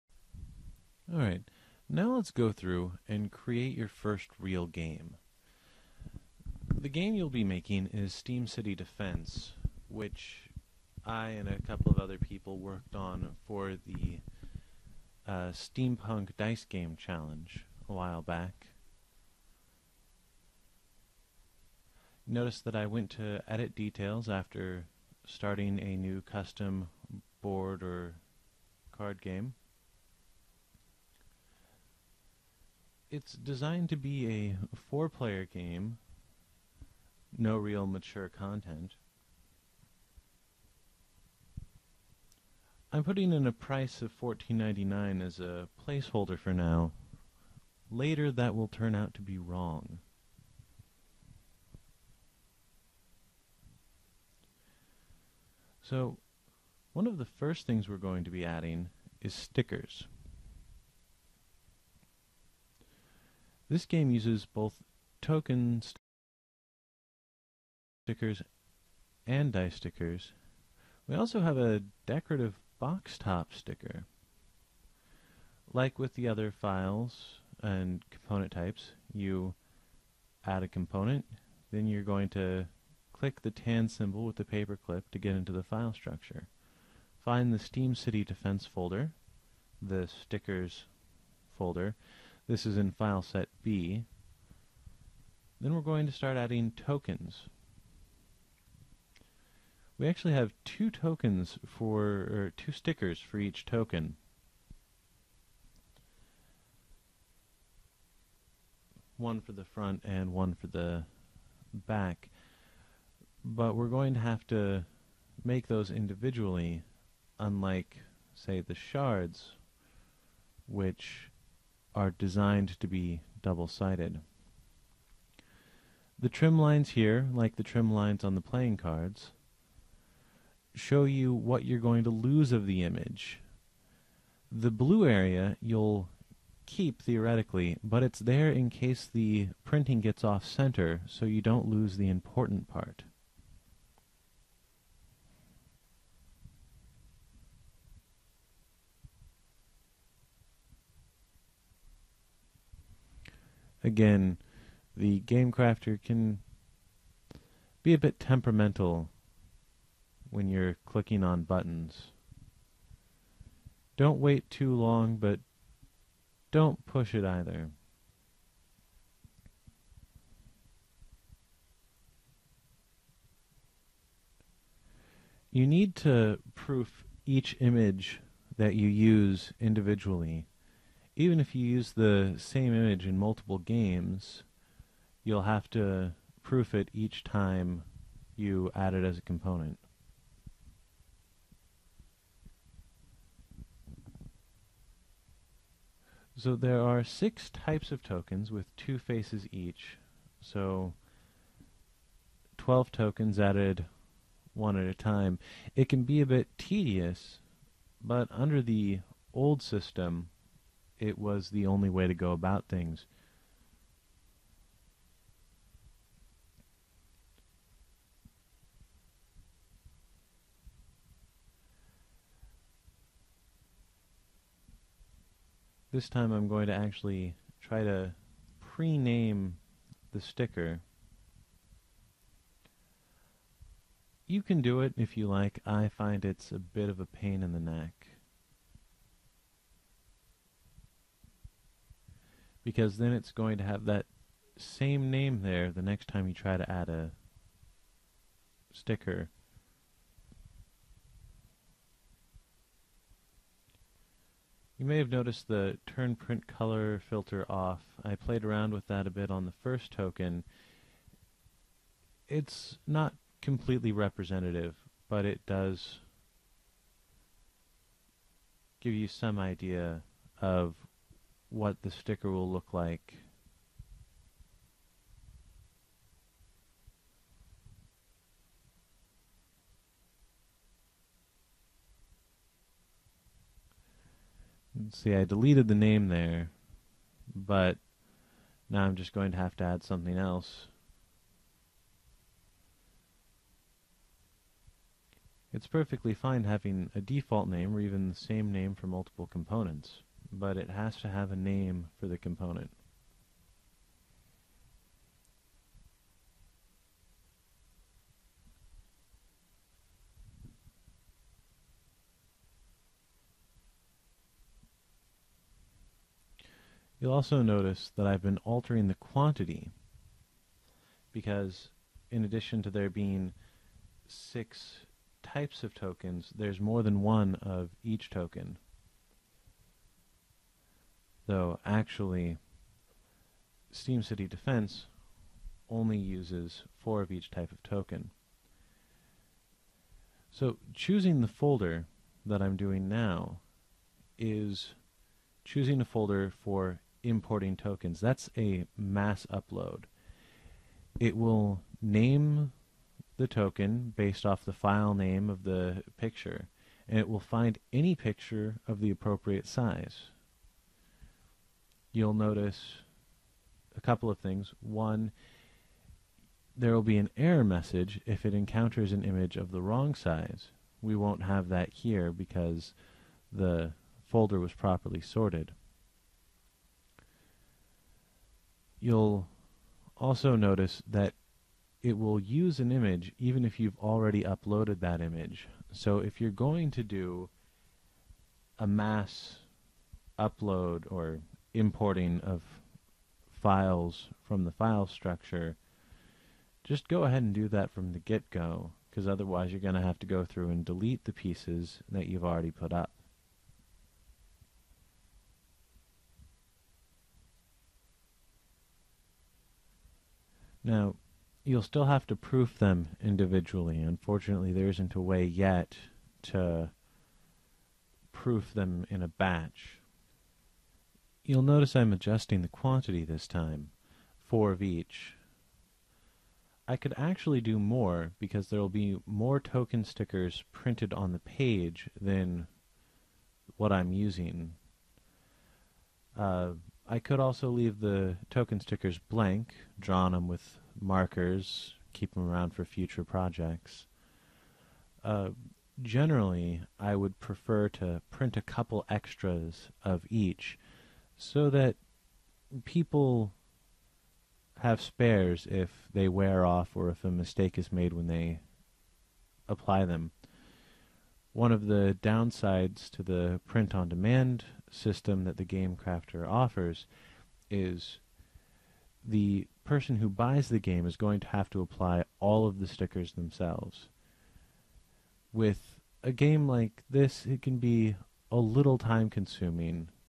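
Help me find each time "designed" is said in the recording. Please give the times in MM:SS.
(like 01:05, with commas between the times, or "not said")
00:33, 02:02.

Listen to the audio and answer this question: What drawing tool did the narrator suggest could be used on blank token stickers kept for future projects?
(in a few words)
markers.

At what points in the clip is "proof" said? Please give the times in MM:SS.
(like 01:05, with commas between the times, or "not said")
02:56, 03:06, 06:52, 06:58.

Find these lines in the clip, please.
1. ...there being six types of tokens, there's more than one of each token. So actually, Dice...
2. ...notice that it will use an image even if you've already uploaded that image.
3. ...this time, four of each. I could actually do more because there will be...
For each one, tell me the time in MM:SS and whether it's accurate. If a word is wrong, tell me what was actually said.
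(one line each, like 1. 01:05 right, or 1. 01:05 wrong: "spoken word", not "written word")
1. 05:22 wrong: "Steam", not "Dice"
2. 06:20 right
3. 07:03 right.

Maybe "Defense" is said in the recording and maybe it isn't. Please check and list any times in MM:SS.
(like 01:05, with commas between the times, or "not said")
00:08, 01:28, 05:34.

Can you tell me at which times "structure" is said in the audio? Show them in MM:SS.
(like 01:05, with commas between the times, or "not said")
01:25, 06:34.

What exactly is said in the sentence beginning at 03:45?
This time I'm going to actually try to pre-name the sticker.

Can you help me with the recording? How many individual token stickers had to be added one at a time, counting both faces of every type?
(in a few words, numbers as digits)
12.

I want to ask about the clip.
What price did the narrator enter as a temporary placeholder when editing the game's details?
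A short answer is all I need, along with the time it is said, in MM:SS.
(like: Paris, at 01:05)
$14.99, at 00:44.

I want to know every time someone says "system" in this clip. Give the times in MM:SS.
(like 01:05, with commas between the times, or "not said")
03:29, 07:44.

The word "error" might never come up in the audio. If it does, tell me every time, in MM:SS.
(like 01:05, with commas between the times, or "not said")
06:07.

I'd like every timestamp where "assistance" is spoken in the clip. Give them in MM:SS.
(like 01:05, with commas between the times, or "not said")
not said.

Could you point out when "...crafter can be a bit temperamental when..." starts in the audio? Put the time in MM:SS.
02:35.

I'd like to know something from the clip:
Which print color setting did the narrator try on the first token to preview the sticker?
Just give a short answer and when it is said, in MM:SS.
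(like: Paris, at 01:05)
turn print color filter off, at 04:15.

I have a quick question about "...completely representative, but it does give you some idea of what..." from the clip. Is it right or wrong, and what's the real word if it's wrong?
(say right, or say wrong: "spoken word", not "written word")
right.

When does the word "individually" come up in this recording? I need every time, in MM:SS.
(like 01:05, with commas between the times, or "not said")
01:55, 02:59, 06:53.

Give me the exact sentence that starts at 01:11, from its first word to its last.
We also have a decorative box top sticker.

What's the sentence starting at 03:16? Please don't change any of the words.
So there are six types of tokens with two faces each.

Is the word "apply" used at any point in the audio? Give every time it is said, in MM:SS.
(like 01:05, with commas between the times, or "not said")
07:39, 07:51.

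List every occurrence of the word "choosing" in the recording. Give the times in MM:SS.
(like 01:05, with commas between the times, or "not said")
05:40, 05:45.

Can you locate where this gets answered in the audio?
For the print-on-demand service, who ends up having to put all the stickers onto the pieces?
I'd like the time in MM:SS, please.
07:49.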